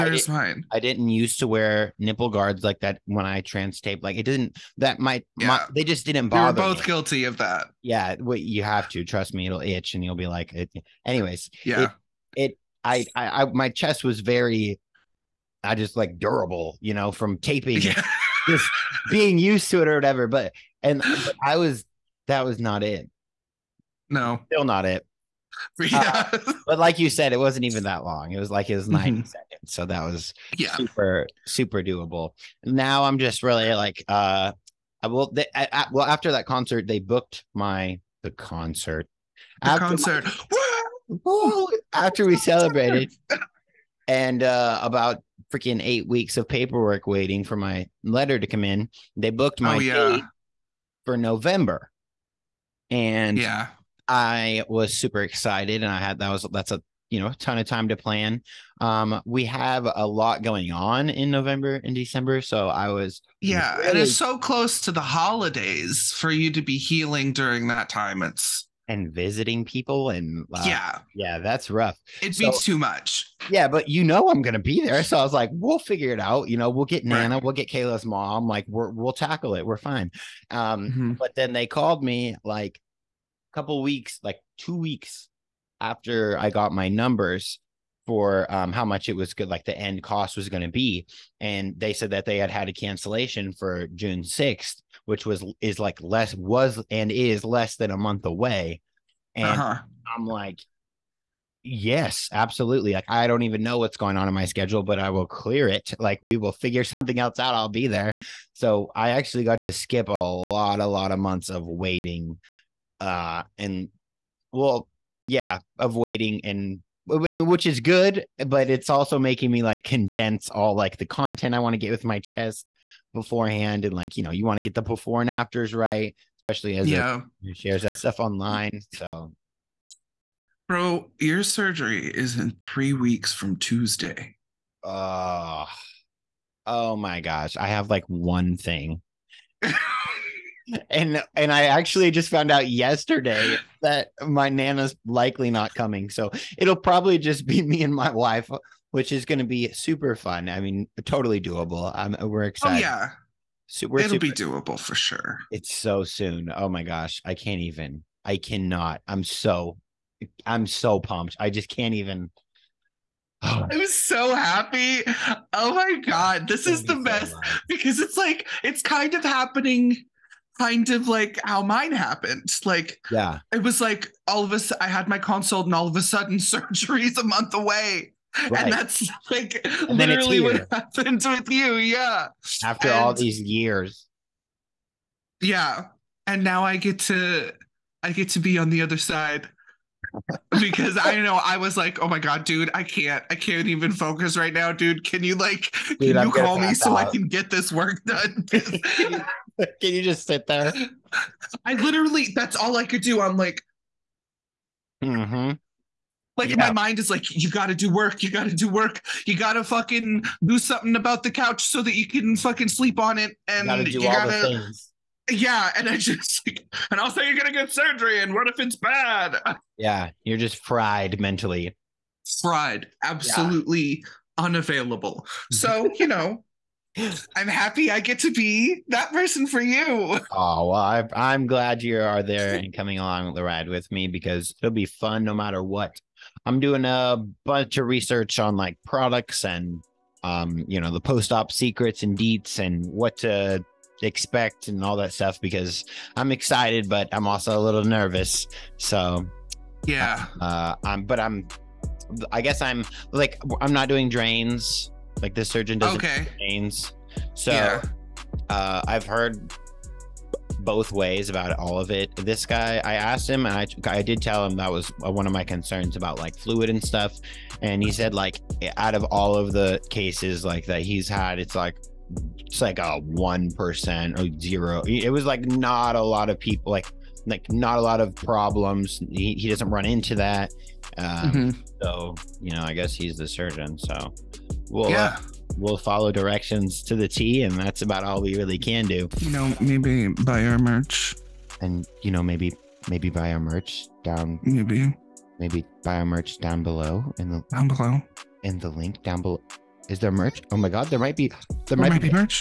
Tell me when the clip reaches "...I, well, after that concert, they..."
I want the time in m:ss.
0:35.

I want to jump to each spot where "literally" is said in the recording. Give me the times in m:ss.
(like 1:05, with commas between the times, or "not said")
2:59, 3:21.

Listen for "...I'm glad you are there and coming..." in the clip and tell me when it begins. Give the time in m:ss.
3:51.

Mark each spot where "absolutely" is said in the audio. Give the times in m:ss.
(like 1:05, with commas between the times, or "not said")
1:42, 3:43.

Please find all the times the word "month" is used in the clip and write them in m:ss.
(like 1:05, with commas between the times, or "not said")
1:37, 1:51, 2:57.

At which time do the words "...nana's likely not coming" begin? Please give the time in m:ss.
2:24.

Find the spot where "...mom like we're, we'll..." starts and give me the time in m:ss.
1:18.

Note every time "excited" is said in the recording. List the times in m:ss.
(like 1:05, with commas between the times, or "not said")
0:55, 2:32, 4:06.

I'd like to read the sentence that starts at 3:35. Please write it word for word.
Yeah, and I just i and also you're gonna get surgery, and what if it's bad?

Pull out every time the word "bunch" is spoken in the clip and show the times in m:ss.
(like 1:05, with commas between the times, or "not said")
3:57.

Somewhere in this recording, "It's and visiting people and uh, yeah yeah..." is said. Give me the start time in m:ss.
1:08.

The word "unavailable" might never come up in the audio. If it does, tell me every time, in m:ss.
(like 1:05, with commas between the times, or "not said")
3:44.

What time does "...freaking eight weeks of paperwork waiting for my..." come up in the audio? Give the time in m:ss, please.
0:45.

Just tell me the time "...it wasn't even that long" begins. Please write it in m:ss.
0:27.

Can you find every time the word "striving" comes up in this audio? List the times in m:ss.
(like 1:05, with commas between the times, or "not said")
not said.